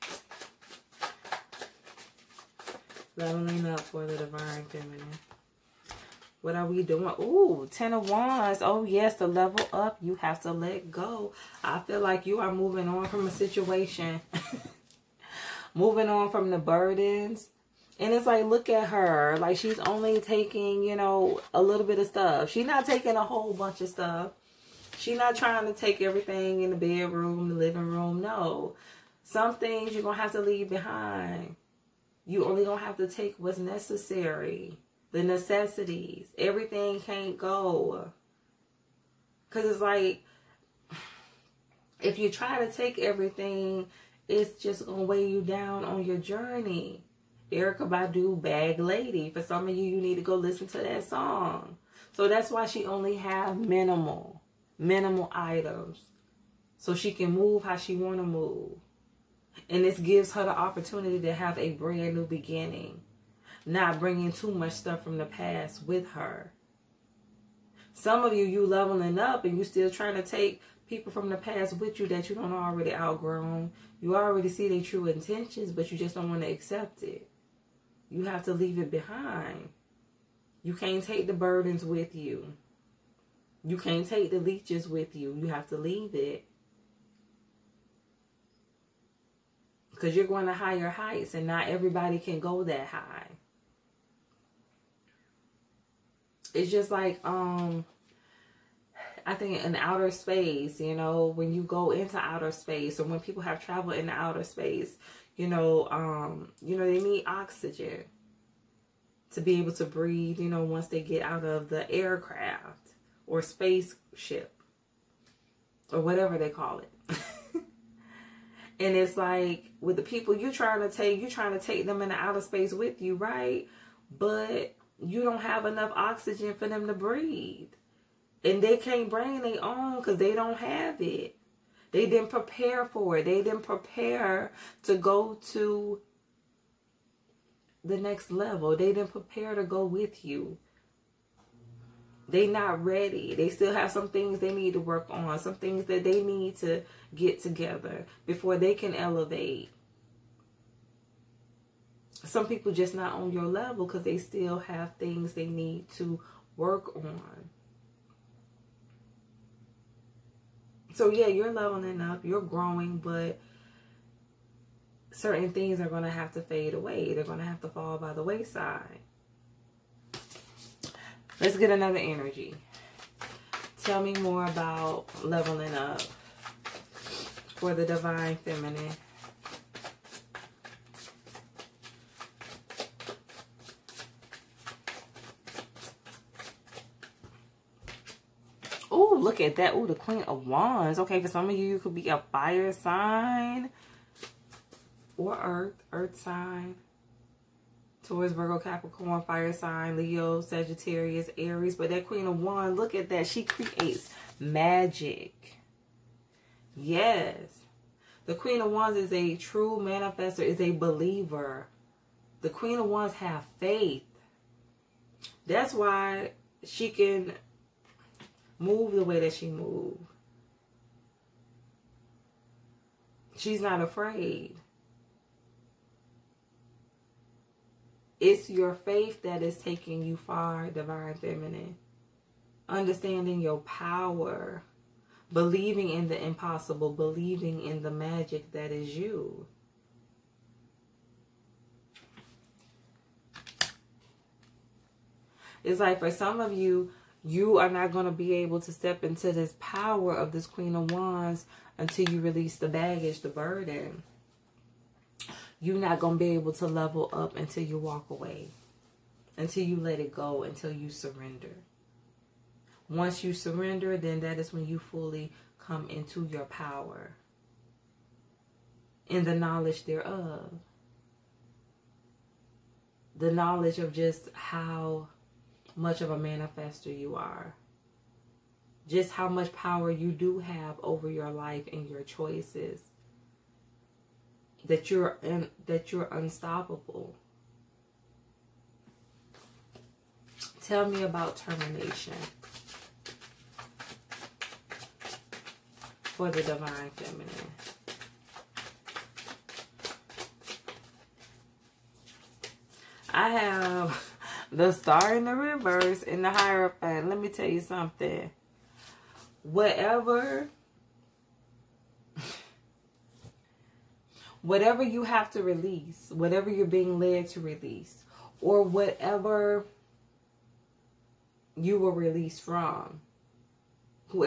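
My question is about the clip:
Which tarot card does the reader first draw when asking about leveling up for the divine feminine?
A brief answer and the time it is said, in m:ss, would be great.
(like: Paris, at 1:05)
Ten of Wands, at 0:07.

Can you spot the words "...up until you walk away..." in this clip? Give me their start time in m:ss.
4:17.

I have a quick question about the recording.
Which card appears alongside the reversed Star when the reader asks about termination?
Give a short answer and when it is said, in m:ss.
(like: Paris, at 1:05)
The Hierophant, at 5:06.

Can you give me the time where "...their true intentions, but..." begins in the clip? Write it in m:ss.
1:14.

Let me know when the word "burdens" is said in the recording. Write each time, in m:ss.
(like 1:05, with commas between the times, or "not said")
0:16, 1:21, 4:13.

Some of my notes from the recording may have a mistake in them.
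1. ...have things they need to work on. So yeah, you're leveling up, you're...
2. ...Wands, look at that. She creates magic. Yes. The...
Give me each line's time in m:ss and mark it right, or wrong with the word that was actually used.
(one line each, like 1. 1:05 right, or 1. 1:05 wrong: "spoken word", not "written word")
1. 2:34 right
2. 3:22 right.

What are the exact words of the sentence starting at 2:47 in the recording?
They're going to have to fall by the wayside.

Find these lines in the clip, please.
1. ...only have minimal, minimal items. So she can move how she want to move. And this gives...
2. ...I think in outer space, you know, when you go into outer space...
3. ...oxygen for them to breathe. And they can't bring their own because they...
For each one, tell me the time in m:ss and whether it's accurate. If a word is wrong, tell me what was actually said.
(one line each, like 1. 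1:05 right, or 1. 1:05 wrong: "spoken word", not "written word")
1. 0:52 right
2. 1:39 right
3. 2:05 right.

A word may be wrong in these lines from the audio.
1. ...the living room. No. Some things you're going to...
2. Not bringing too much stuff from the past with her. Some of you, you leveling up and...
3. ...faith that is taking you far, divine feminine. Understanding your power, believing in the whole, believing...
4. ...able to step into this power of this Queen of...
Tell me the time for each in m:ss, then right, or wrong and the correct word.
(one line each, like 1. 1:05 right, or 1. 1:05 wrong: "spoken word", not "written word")
1. 0:27 right
2. 1:03 right
3. 3:48 wrong: "impossible", not "whole"
4. 4:08 right.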